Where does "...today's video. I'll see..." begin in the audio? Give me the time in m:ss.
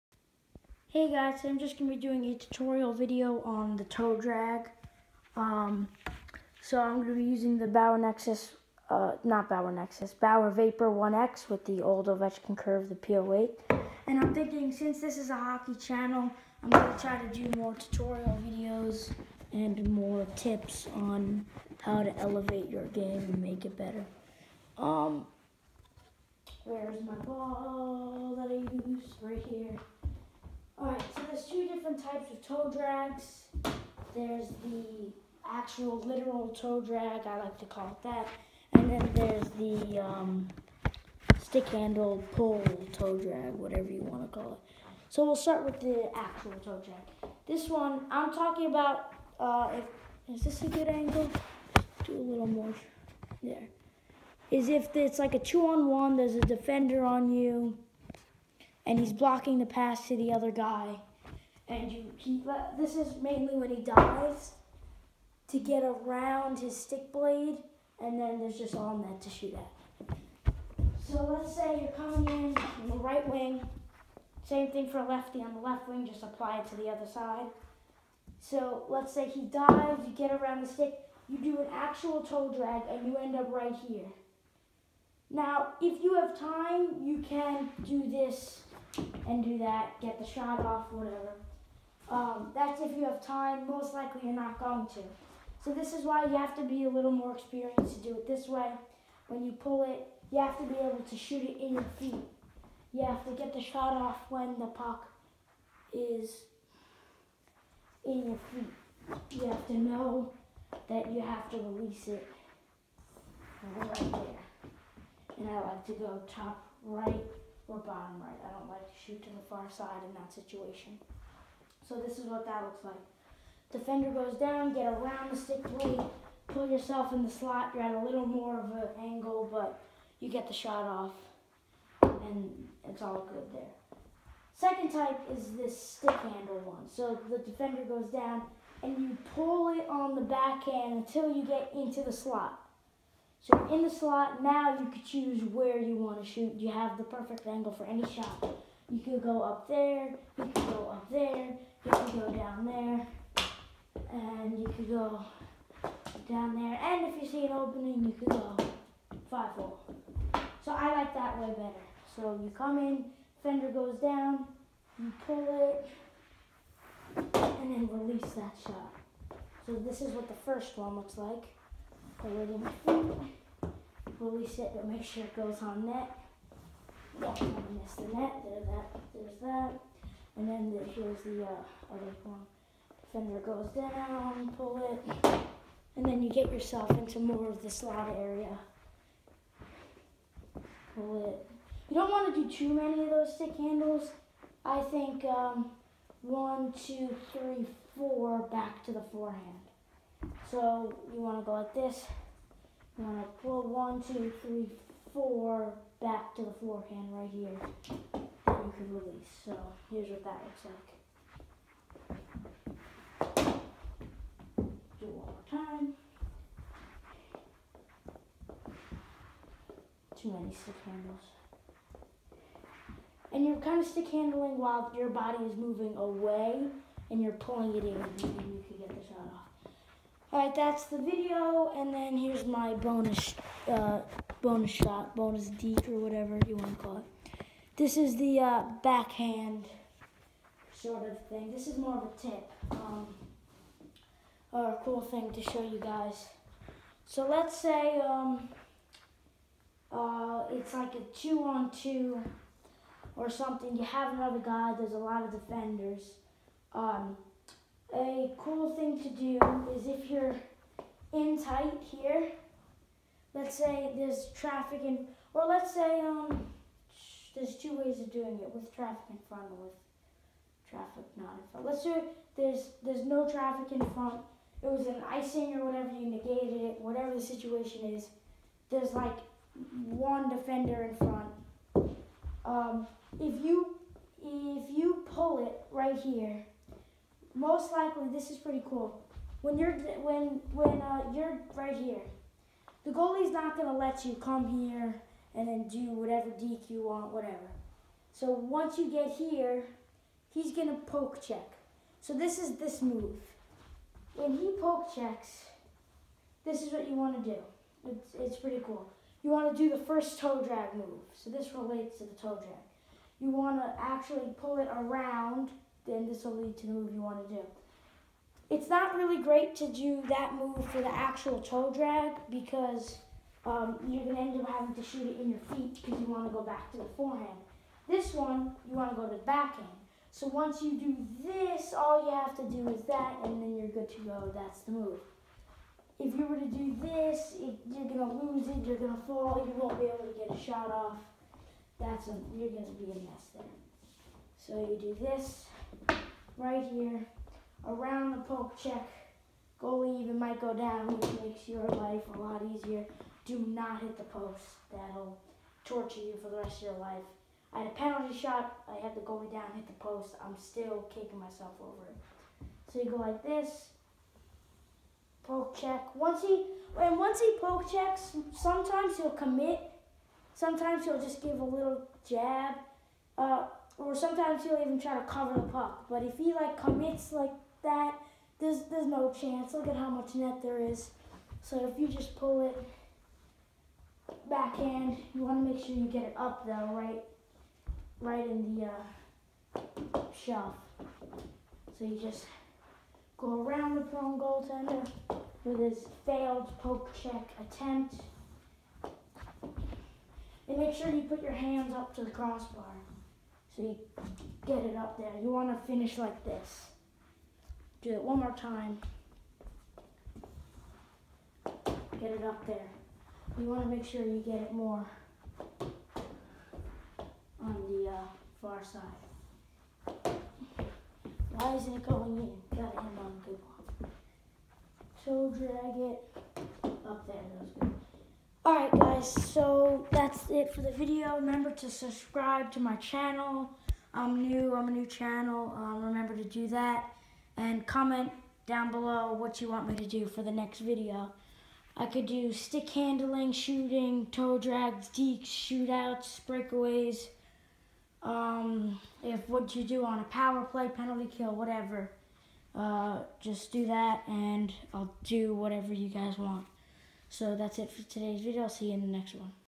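7:37.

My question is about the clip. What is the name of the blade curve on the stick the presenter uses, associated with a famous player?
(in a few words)
P08.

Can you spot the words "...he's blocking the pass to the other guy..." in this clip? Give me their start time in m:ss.
0:58.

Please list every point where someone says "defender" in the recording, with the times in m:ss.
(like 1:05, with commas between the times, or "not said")
0:56, 2:03, 2:17, 4:15, 4:40.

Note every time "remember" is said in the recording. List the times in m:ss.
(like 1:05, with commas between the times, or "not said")
7:11, 7:15.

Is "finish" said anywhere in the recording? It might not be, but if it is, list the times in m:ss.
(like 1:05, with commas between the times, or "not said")
6:45.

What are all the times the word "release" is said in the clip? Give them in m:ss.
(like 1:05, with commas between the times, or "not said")
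1:51, 2:47, 2:54, 3:28.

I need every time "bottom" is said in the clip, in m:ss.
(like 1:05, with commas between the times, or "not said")
1:57.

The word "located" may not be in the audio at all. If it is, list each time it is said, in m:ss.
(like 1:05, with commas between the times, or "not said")
not said.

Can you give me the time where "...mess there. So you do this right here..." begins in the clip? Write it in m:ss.
5:42.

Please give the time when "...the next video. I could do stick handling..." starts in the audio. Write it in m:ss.
7:20.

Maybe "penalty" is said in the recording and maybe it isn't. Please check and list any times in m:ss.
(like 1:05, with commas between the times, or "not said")
5:57, 7:30.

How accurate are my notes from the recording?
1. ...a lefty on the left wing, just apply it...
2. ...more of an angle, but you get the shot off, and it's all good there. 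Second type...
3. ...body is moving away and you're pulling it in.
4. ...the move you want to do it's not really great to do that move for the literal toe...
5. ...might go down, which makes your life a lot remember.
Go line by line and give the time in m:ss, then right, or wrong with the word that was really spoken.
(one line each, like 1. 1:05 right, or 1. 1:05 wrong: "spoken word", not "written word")
1. 1:14 right
2. 2:08 right
3. 3:45 right
4. 5:16 wrong: "actual", not "literal"
5. 5:50 wrong: "easier", not "remember".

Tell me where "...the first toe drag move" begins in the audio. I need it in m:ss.
5:09.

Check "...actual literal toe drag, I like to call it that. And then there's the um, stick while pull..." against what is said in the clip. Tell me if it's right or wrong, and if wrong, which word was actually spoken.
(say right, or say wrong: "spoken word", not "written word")
wrong: "handle", not "while".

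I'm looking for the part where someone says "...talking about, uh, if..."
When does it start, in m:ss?
0:48.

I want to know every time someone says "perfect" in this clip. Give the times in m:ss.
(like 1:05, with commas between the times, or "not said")
2:27.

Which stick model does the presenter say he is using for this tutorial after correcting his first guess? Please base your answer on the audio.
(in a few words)
Bauer Vapor 1X.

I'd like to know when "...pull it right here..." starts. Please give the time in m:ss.
4:45.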